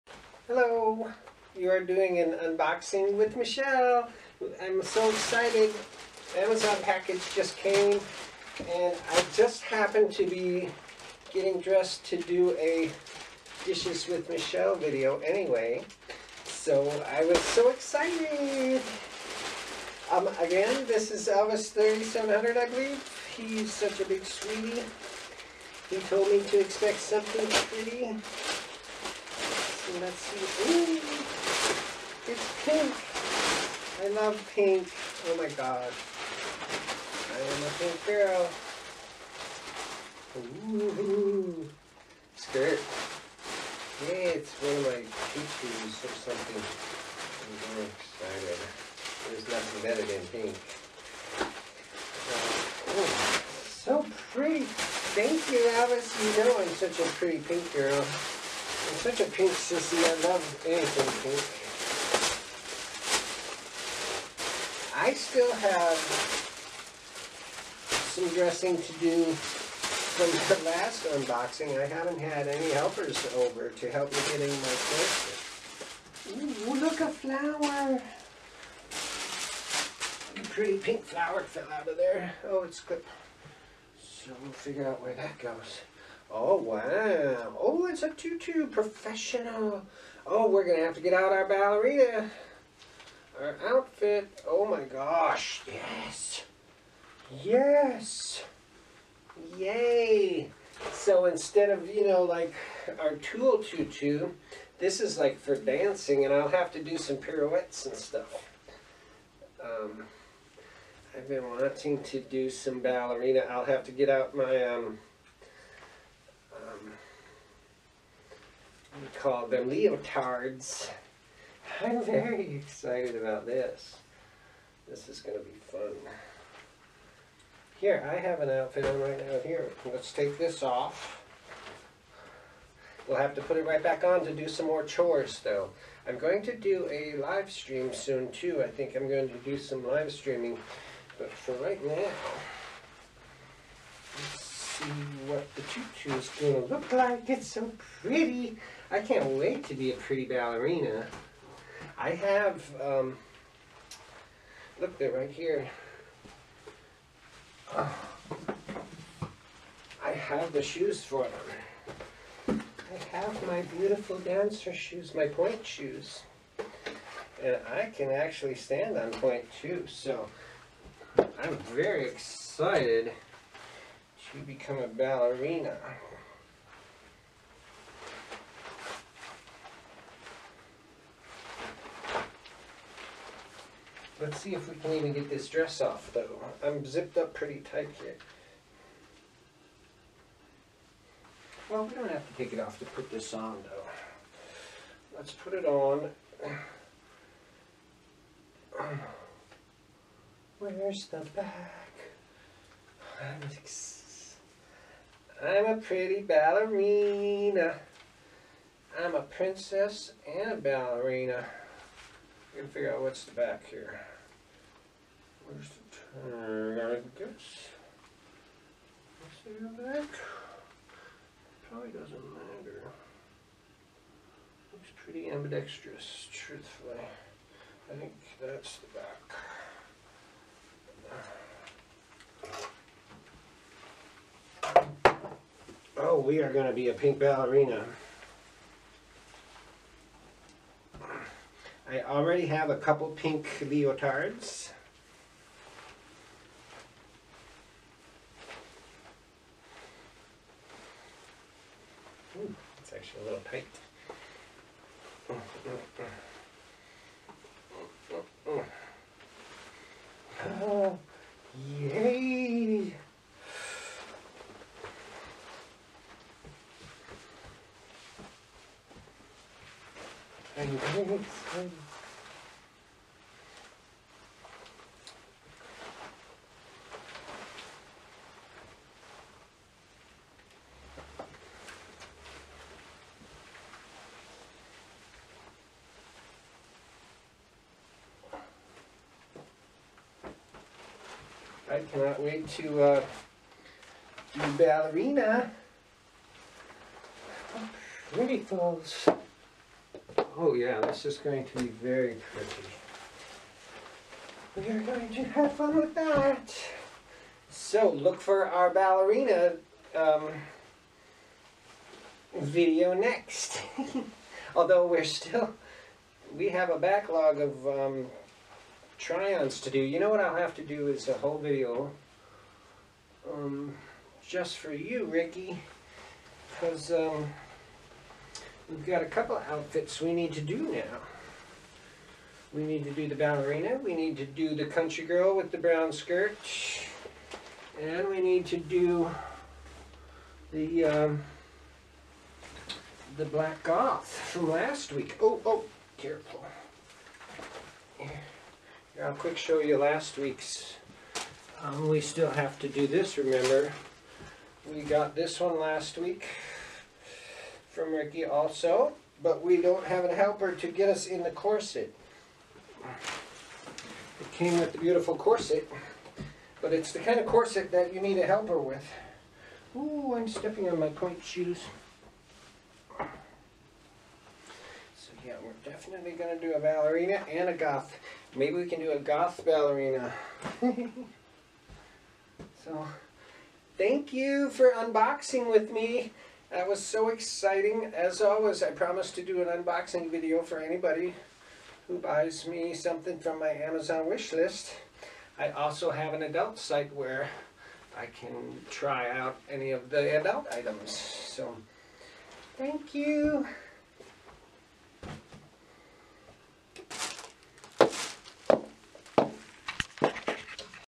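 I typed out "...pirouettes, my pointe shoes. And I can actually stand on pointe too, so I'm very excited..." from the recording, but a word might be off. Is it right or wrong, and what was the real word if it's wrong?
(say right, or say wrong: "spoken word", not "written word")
wrong: "shoes", not "pirouettes".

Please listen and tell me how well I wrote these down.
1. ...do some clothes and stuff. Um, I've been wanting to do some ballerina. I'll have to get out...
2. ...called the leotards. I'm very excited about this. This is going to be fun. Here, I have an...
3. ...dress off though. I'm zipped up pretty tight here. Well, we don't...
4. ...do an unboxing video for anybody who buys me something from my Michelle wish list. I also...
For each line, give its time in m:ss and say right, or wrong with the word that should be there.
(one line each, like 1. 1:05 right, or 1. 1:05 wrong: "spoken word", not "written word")
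1. 1:46 wrong: "pirouettes", not "clothes"
2. 1:59 right
3. 3:05 right
4. 6:29 wrong: "Amazon", not "Michelle".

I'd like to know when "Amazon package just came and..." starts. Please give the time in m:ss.
0:06.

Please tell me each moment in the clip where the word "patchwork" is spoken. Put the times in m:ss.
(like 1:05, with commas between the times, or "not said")
not said.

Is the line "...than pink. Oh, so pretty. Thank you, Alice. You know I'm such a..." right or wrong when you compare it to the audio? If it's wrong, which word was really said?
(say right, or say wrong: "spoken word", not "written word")
right.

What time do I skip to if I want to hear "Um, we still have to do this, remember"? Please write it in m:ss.
5:51.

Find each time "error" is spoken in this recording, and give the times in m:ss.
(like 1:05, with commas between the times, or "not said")
not said.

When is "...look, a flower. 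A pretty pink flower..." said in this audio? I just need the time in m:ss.
1:16.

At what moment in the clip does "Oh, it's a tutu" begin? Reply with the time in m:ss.
1:27.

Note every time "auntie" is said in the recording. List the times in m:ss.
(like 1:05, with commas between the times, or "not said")
not said.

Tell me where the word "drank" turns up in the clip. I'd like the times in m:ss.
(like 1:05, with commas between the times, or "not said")
not said.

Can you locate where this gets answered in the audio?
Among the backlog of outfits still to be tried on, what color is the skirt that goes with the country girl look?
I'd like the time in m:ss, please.
5:35.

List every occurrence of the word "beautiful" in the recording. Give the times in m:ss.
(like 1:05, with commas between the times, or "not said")
2:43, 6:04.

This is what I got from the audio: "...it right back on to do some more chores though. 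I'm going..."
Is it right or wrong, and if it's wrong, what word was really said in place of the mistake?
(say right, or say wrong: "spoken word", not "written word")
right.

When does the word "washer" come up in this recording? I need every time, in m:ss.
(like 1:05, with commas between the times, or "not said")
not said.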